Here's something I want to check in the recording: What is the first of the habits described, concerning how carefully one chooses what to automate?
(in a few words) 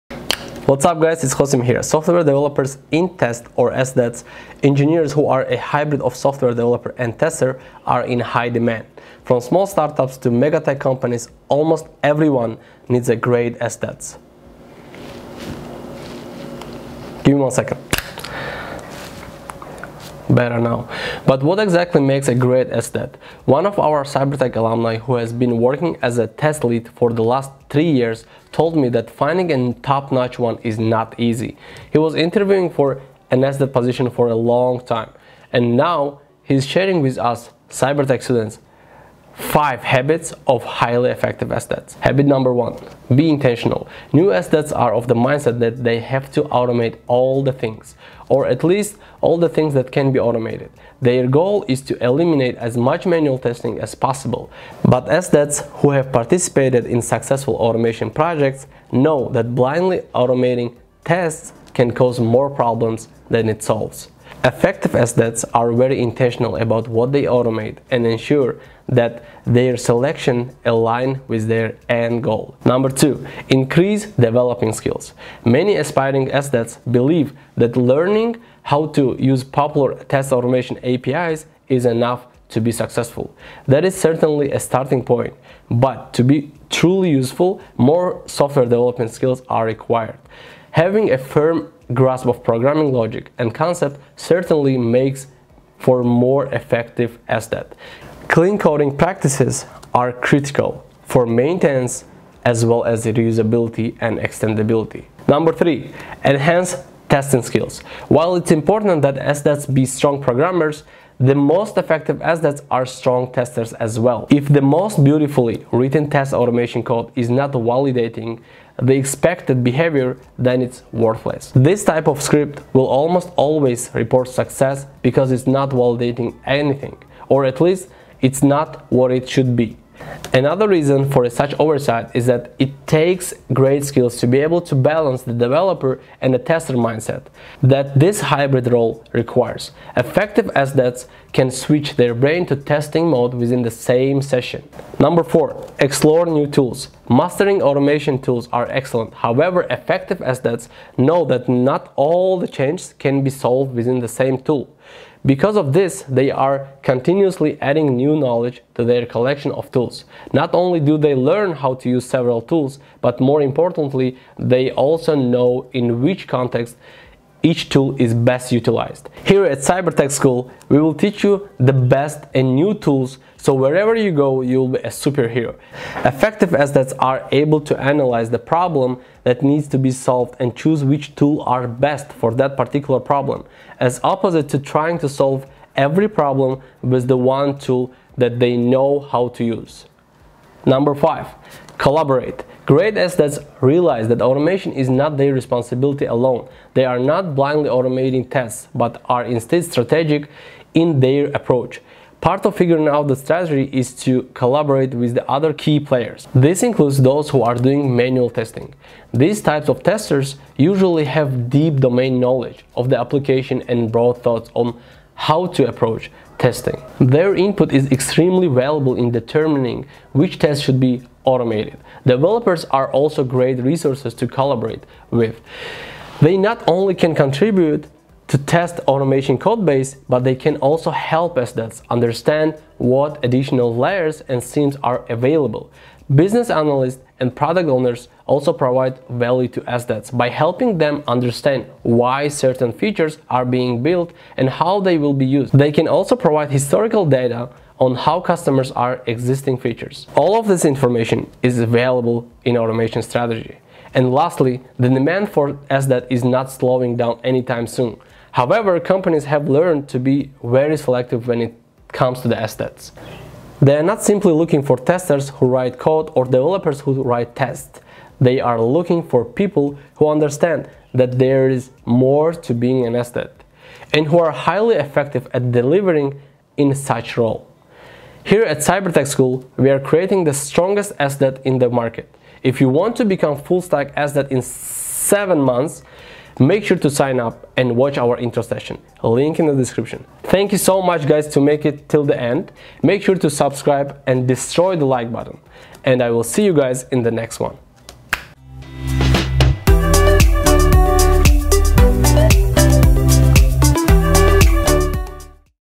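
Be intentional.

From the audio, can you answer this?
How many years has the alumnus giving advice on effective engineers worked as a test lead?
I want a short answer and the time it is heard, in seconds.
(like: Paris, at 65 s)
3, at 27 s.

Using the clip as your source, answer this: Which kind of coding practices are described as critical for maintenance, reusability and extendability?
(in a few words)
Clean coding.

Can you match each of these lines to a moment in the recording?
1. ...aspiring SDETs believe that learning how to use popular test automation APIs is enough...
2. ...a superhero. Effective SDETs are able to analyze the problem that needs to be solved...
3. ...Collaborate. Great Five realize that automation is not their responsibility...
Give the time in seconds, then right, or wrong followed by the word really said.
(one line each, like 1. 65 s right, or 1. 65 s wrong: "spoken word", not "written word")
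1. 75 s right
2. 174 s right
3. 191 s wrong: "SDETs", not "Five".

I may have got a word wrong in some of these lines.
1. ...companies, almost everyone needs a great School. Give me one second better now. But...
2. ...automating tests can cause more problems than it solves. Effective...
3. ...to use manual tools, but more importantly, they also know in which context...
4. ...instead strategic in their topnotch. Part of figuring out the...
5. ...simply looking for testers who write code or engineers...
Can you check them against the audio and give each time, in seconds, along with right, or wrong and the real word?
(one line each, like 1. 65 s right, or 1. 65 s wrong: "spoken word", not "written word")
1. 10 s wrong: "SDETs", not "School"
2. 60 s right
3. 161 s wrong: "several", not "manual"
4. 199 s wrong: "approach", not "topnotch"
5. 264 s wrong: "developers", not "engineers".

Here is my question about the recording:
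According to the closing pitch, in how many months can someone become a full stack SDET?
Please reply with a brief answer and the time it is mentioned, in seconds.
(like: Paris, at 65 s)
7 months, at 284 s.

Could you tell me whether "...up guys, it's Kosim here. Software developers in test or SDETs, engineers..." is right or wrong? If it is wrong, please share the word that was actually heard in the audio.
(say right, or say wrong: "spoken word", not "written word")
right.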